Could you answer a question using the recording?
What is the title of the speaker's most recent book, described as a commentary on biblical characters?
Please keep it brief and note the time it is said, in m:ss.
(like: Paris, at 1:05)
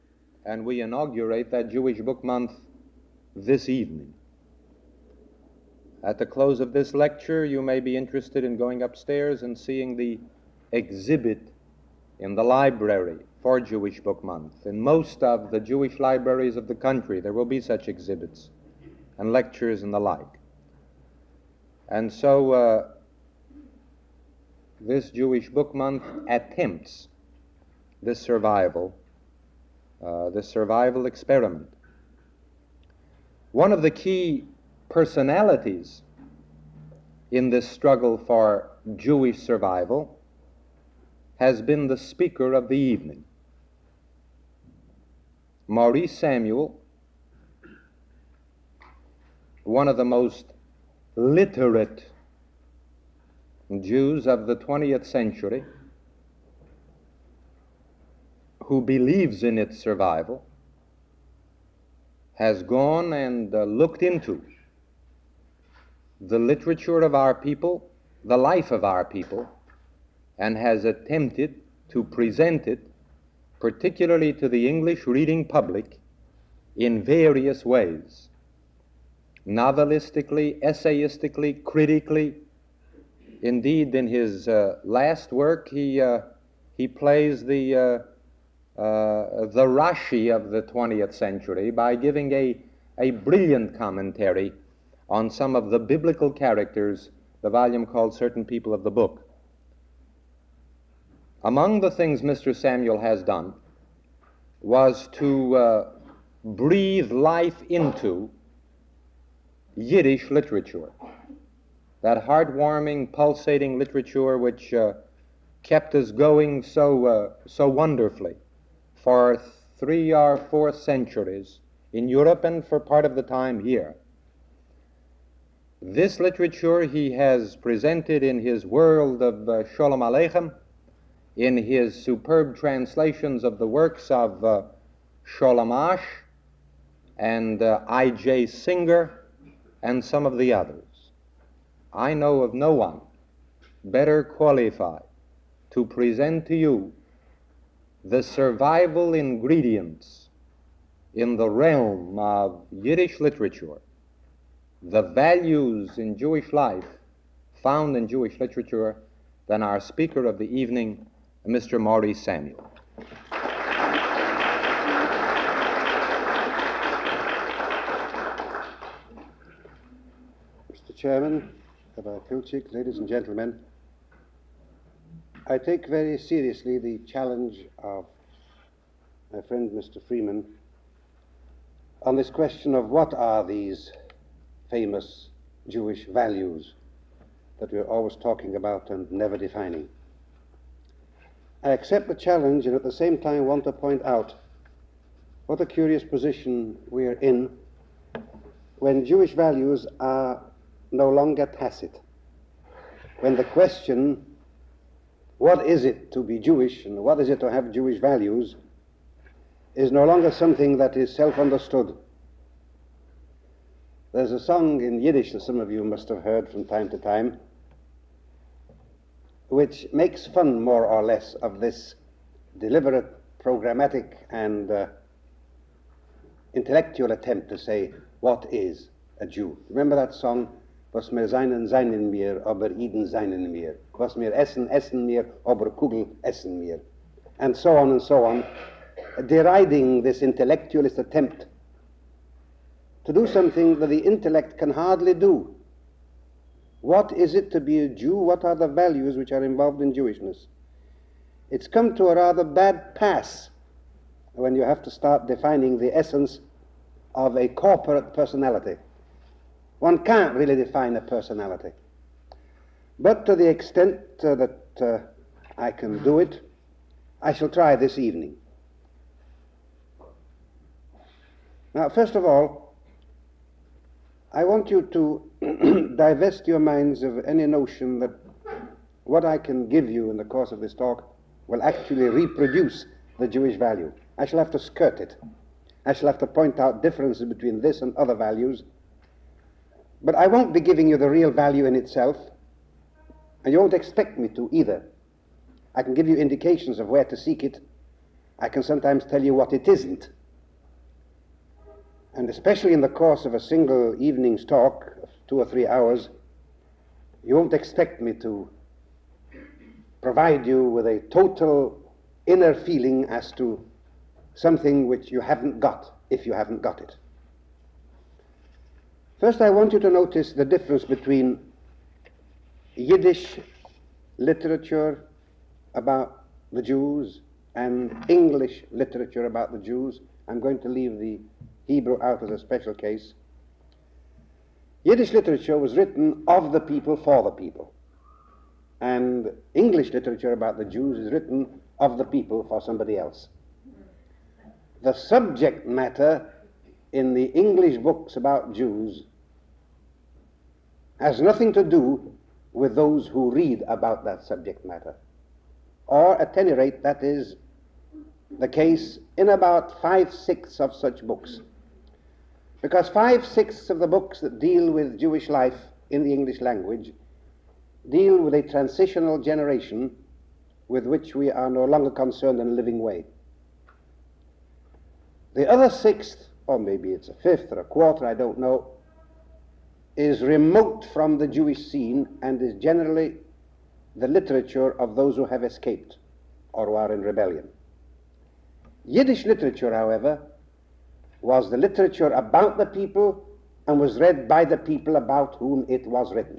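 Certain People of the Book, at 1:38.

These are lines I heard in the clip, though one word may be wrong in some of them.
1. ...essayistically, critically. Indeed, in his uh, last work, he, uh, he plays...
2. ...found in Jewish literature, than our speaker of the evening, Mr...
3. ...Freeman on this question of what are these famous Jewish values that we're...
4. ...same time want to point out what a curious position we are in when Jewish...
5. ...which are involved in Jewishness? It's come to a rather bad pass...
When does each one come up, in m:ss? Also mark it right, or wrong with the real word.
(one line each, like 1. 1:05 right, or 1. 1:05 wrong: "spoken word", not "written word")
1. 1:20 right
2. 2:37 right
3. 3:00 right
4. 3:12 right
5. 4:09 right.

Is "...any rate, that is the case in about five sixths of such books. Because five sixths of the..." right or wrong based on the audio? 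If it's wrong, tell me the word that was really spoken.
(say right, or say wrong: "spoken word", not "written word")
right.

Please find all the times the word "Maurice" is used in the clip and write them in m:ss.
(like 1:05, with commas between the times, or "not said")
0:45, 2:41.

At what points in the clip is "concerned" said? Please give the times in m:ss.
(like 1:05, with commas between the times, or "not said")
6:11.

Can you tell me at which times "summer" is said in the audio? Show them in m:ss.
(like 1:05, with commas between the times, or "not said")
not said.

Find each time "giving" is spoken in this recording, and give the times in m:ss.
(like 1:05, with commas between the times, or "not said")
1:31, 4:50.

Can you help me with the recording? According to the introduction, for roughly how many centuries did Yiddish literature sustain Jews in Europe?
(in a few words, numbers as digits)
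three or four.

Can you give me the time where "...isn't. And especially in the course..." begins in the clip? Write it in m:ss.
4:59.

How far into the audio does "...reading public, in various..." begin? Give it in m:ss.
1:15.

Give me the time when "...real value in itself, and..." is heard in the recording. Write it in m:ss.
4:51.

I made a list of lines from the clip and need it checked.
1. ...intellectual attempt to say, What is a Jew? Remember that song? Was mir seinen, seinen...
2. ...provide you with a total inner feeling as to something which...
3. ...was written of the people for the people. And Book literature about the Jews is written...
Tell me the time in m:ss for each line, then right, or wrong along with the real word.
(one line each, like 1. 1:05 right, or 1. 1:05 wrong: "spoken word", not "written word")
1. 3:46 right
2. 5:10 right
3. 5:35 wrong: "English", not "Book".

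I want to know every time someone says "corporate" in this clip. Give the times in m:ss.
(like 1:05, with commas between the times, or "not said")
4:17.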